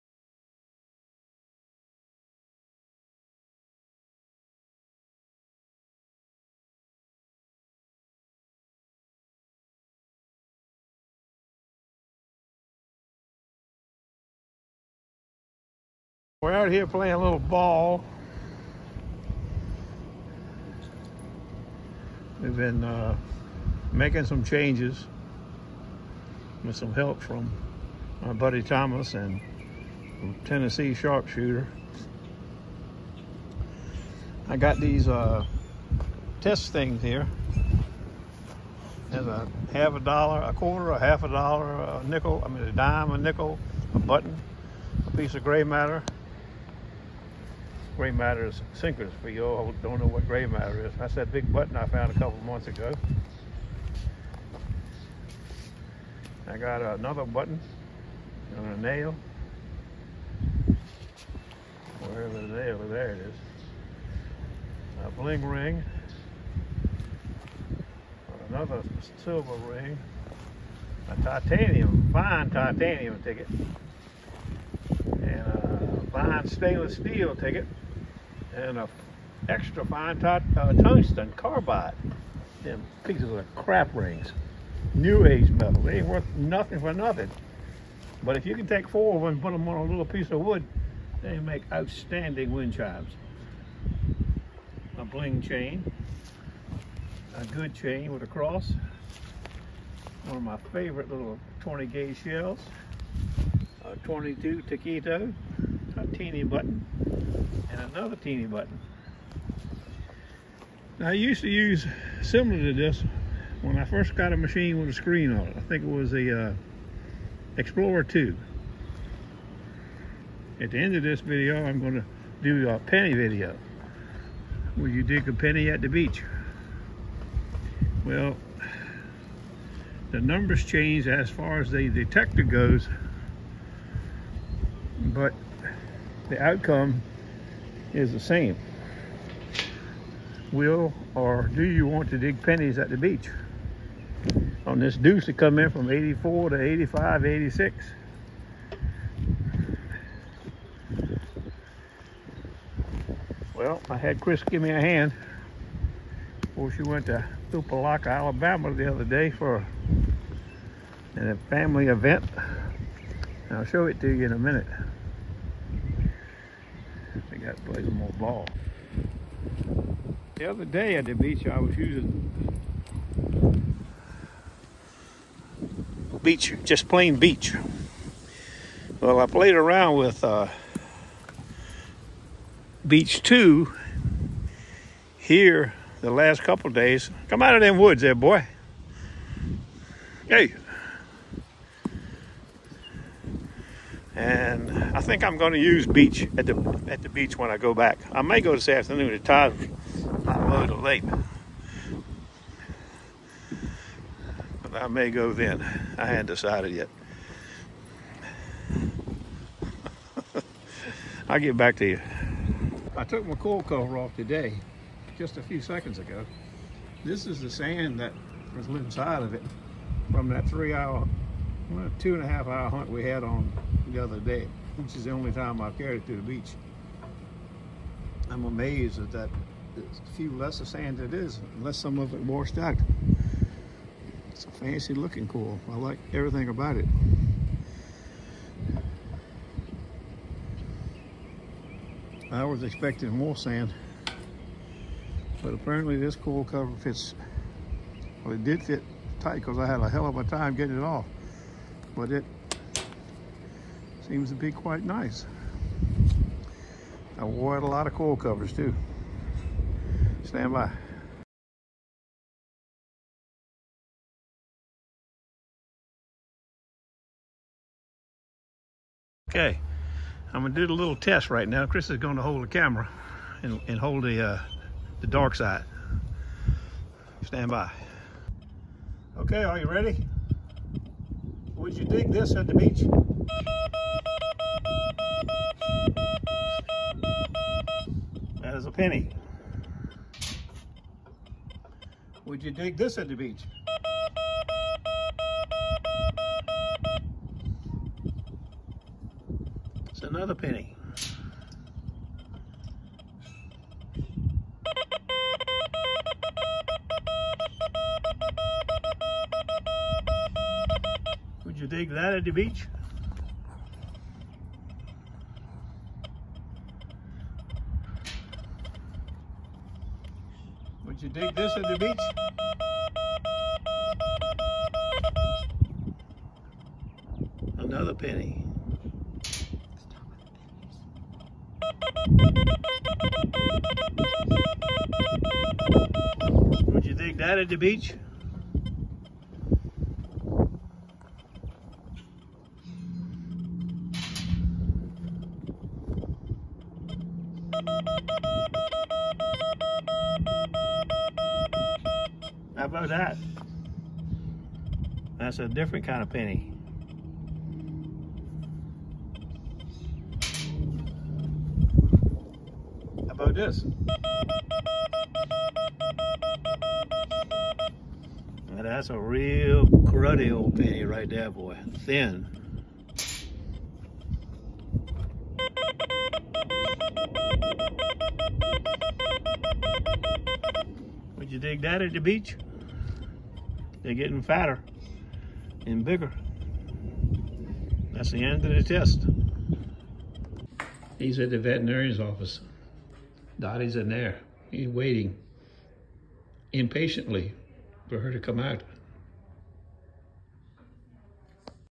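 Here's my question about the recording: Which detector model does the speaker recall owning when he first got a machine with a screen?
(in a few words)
Explorer 2.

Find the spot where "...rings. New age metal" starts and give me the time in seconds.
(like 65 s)
83 s.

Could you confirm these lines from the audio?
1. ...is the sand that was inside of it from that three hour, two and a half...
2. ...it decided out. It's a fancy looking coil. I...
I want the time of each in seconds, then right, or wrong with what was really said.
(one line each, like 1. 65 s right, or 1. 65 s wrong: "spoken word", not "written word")
1. 217 s right
2. 232 s wrong: "washed", not "decided".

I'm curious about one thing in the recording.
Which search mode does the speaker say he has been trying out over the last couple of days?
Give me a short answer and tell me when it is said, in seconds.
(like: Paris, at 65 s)
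beach two, at 182 s.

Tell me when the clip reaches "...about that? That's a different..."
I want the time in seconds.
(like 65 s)
352 s.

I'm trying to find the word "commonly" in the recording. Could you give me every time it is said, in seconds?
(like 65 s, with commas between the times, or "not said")
not said.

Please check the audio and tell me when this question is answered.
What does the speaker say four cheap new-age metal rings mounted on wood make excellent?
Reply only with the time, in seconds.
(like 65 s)
92 s.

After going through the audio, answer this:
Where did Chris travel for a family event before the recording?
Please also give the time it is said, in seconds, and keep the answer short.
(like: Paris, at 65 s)
Tupalaca, Alabama, at 157 s.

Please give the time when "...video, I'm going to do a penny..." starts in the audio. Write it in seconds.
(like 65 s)
121 s.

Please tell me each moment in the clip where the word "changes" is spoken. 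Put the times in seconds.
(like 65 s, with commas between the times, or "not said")
24 s, 130 s.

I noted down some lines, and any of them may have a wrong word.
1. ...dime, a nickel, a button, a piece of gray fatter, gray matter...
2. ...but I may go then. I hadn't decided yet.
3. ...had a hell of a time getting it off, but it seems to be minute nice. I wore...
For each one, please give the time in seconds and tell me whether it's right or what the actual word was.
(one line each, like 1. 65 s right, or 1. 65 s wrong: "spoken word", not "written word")
1. 42 s wrong: "matter", not "fatter"
2. 204 s right
3. 249 s wrong: "quite", not "minute".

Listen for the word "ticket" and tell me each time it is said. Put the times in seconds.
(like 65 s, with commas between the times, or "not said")
73 s, 77 s.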